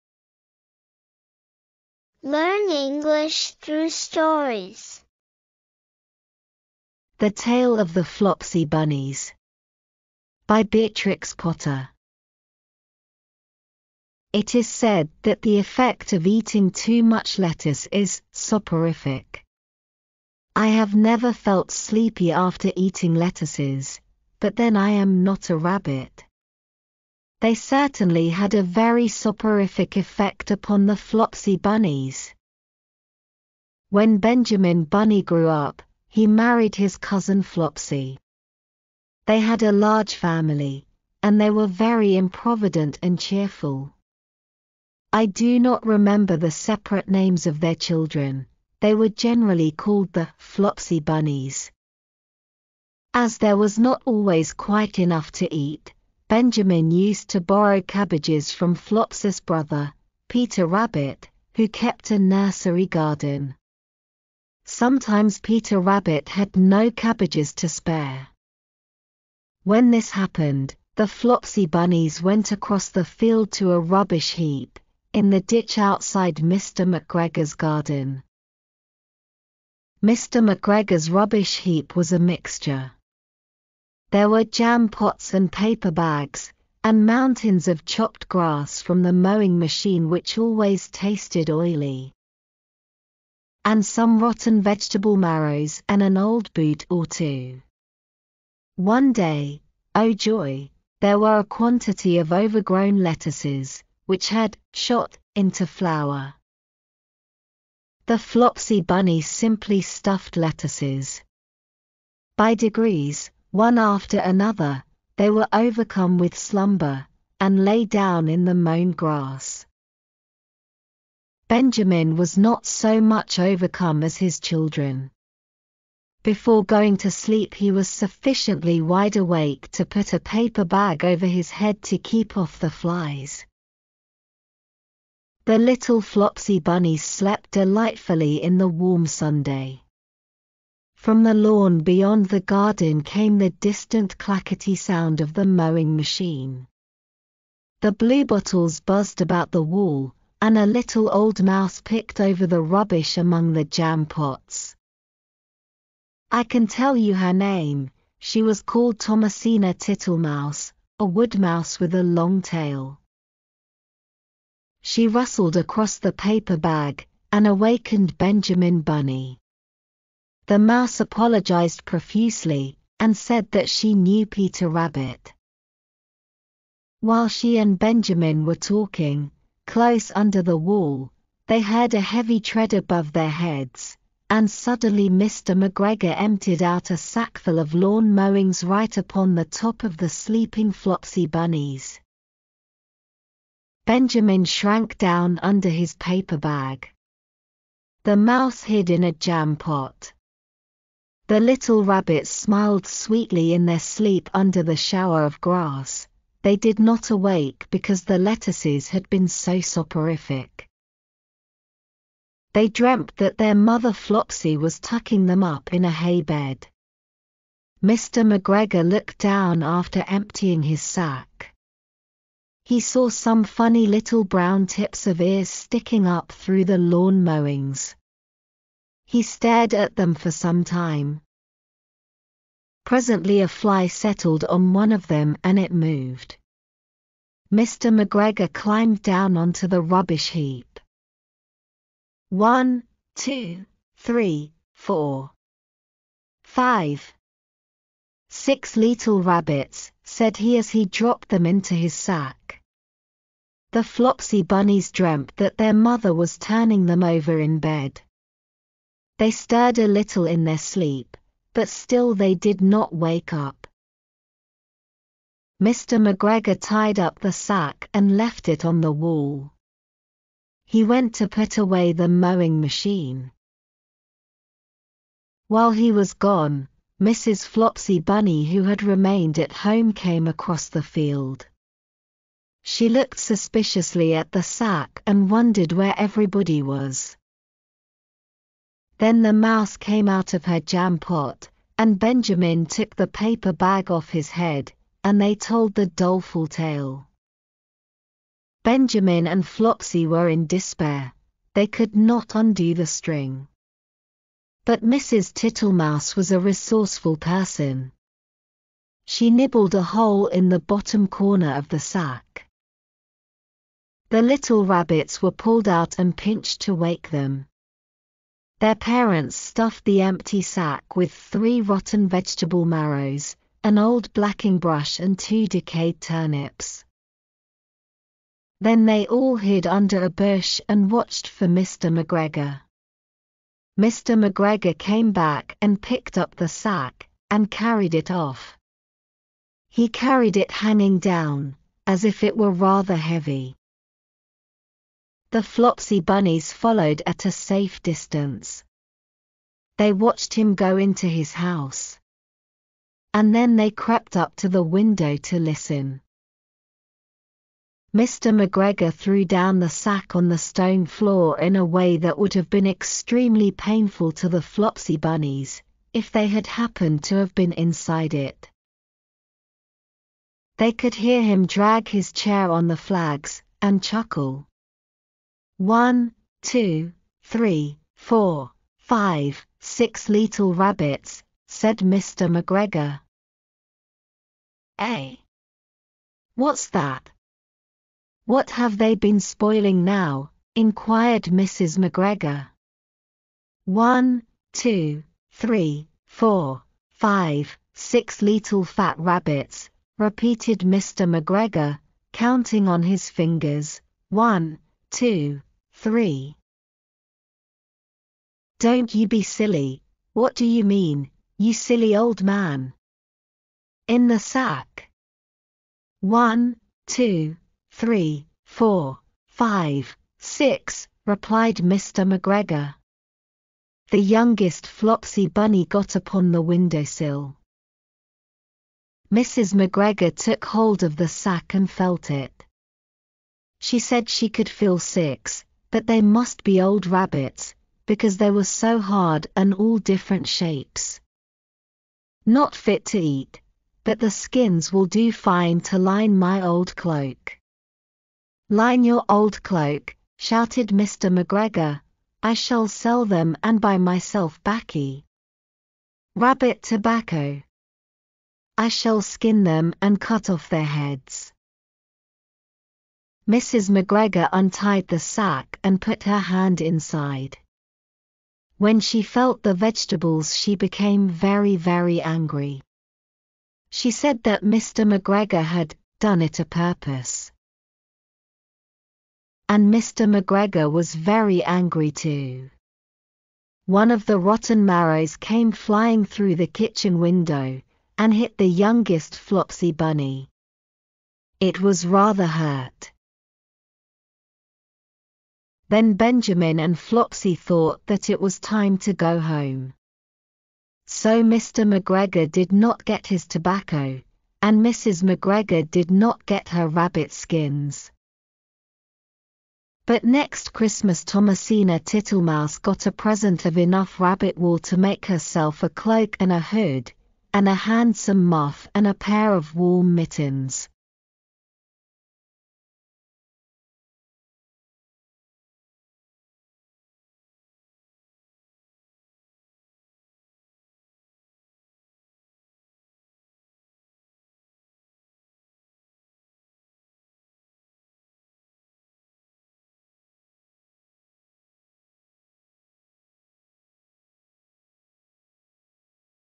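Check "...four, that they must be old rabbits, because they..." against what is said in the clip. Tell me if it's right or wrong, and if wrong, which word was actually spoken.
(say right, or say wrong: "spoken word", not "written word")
wrong: "six", not "four".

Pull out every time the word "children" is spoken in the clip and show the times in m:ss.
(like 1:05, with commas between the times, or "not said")
0:47, 2:04.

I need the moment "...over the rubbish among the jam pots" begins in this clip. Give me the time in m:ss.
2:32.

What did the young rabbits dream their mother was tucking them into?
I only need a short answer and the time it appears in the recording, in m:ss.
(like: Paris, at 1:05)
A hay bed, at 3:35.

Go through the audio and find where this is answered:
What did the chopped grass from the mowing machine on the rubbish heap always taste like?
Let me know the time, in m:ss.
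1:31.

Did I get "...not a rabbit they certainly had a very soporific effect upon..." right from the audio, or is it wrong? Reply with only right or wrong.
right.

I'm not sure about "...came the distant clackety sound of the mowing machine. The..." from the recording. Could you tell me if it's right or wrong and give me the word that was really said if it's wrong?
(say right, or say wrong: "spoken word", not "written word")
right.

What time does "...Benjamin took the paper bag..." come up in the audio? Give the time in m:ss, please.
4:51.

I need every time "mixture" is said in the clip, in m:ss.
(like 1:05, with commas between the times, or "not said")
1:22.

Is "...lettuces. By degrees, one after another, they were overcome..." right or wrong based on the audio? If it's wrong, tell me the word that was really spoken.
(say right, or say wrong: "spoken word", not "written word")
right.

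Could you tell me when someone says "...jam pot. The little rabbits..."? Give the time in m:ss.
3:19.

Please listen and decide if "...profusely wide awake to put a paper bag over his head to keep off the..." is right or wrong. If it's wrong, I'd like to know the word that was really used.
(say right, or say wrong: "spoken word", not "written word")
wrong: "sufficiently", not "profusely".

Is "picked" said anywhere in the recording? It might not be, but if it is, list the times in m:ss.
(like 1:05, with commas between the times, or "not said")
2:31, 5:35.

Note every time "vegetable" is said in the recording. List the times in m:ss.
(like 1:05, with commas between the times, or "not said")
1:34, 5:22, 7:49.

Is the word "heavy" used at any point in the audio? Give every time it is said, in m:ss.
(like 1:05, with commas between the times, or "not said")
3:02, 5:42.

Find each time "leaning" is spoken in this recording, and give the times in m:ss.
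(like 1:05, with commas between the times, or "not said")
not said.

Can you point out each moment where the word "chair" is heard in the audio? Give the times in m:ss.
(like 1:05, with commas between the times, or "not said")
6:12.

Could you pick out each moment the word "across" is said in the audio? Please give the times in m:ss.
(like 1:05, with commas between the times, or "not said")
1:12, 2:45, 4:40.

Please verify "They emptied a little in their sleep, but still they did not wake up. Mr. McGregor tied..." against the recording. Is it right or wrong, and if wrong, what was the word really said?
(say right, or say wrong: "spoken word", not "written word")
wrong: "stirred", not "emptied".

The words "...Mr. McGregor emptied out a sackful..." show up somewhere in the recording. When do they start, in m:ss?
3:05.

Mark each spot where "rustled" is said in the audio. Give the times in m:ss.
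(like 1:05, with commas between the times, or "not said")
2:45.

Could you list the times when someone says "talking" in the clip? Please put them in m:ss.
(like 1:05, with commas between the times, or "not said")
2:58.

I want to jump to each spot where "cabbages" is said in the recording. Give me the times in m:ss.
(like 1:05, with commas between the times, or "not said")
0:57, 1:06.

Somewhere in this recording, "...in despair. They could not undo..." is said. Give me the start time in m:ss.
5:00.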